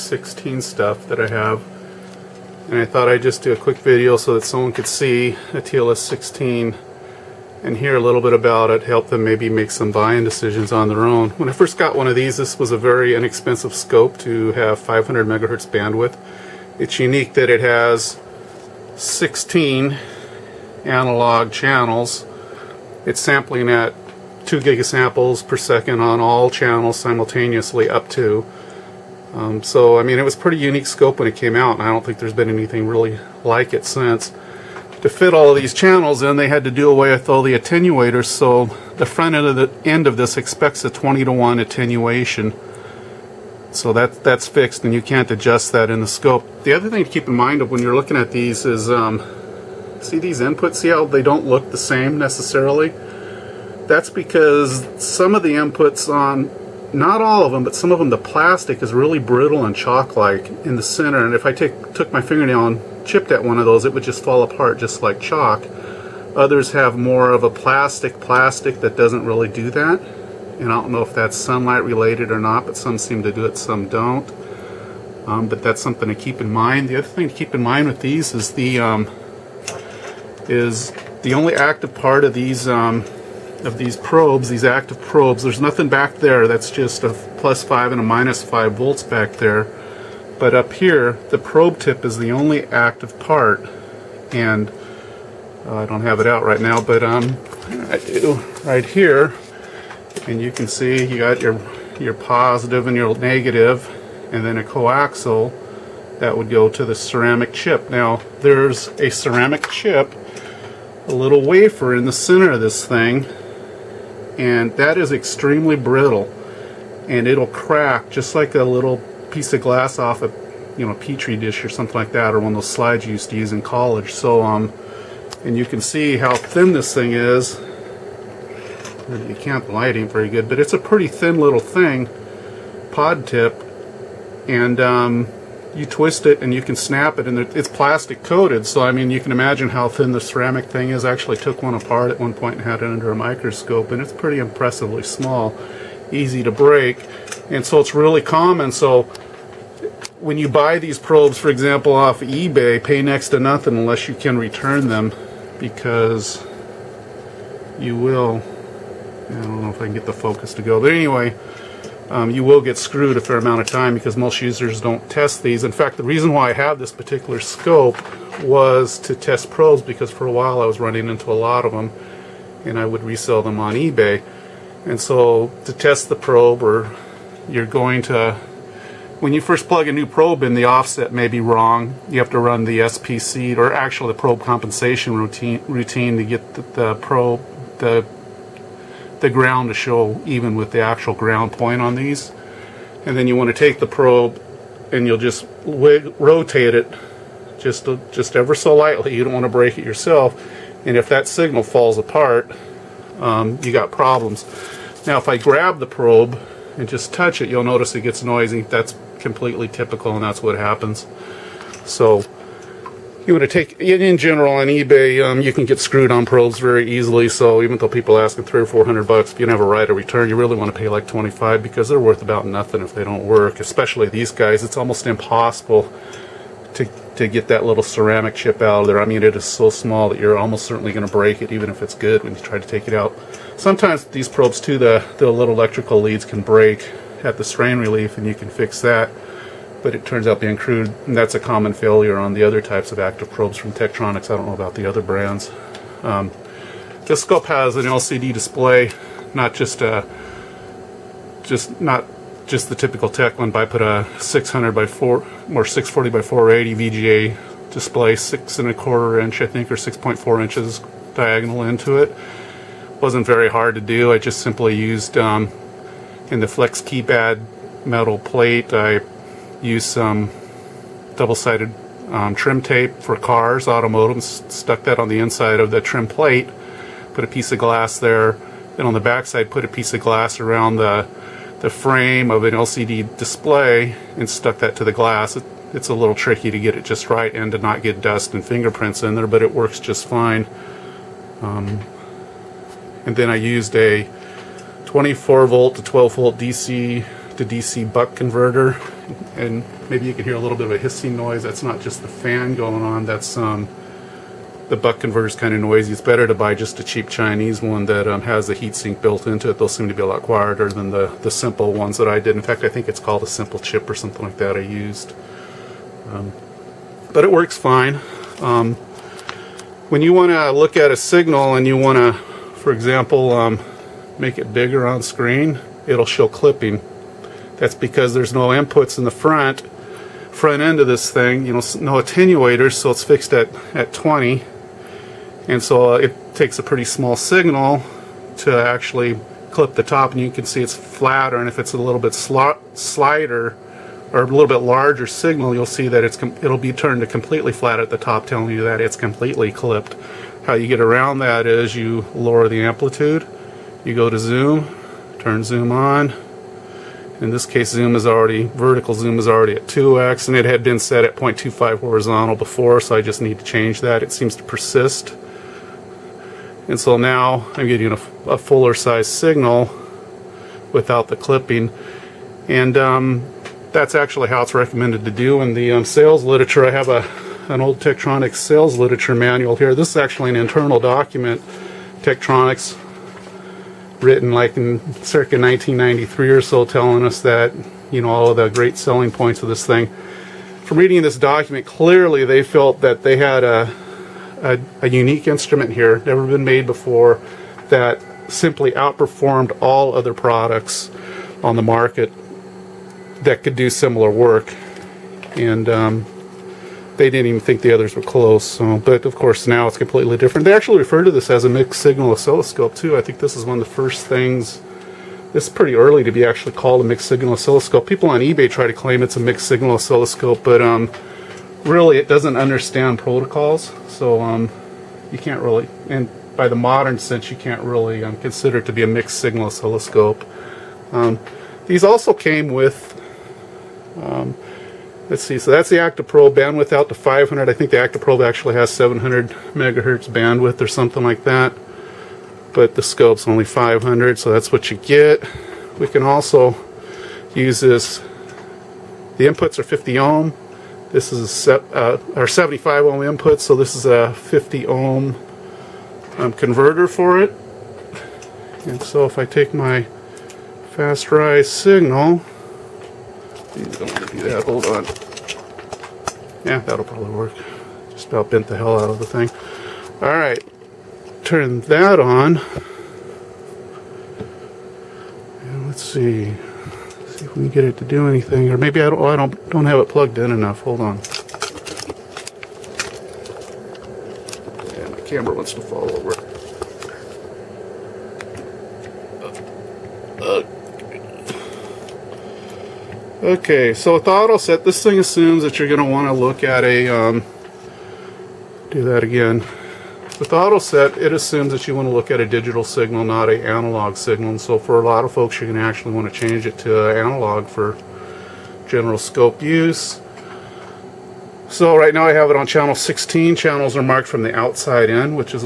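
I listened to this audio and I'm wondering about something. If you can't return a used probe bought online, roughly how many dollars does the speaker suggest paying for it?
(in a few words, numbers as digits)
$25.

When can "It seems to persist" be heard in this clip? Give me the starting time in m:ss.
6:04.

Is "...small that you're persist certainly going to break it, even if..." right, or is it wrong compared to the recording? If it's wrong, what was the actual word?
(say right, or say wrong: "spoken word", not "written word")
wrong: "almost", not "persist".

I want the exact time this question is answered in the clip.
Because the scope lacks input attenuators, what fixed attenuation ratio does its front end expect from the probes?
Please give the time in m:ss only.
0:40.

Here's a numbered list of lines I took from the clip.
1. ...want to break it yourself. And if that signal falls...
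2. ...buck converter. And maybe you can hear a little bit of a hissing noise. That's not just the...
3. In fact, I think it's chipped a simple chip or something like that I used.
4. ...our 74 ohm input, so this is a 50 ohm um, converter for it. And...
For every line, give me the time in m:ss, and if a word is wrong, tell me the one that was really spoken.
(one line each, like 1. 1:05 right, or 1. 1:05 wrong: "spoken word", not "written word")
1. 3:19 right
2. 4:57 right
3. 5:12 wrong: "called", not "chipped"
4. 7:32 wrong: "75", not "74".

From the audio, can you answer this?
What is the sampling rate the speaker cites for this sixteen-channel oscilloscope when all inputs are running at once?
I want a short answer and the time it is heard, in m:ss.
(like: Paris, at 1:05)
2 gigasamples per second, at 0:24.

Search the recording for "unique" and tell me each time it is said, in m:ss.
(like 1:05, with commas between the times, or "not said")
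0:16, 0:30, 6:34.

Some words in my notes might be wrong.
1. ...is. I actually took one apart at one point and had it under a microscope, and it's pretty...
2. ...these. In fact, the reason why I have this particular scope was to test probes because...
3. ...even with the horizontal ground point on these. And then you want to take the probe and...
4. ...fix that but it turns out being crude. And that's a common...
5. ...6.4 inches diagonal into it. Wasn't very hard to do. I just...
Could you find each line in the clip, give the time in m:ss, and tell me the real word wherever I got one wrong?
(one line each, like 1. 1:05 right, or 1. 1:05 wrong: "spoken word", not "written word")
1. 2:20 right
2. 2:45 right
3. 3:10 wrong: "actual", not "horizontal"
4. 3:58 right
5. 4:19 right.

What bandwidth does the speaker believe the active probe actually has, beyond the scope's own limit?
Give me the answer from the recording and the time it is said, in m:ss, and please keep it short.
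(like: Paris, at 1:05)
700 MHz, at 7:18.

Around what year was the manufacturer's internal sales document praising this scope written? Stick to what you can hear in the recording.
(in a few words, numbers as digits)
1993.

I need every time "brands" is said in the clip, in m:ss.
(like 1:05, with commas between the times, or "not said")
4:05.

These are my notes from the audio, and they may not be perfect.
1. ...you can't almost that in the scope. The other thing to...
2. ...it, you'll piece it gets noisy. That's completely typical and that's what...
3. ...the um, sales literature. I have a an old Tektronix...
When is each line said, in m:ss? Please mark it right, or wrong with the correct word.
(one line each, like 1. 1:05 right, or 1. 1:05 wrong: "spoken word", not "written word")
1. 0:44 wrong: "adjust", not "almost"
2. 3:27 wrong: "notice", not "piece"
3. 6:15 right.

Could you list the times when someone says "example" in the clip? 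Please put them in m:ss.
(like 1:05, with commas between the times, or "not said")
2:31, 5:22.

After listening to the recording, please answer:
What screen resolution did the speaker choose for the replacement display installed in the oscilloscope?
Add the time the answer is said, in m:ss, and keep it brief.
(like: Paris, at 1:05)
640 by 480, at 4:15.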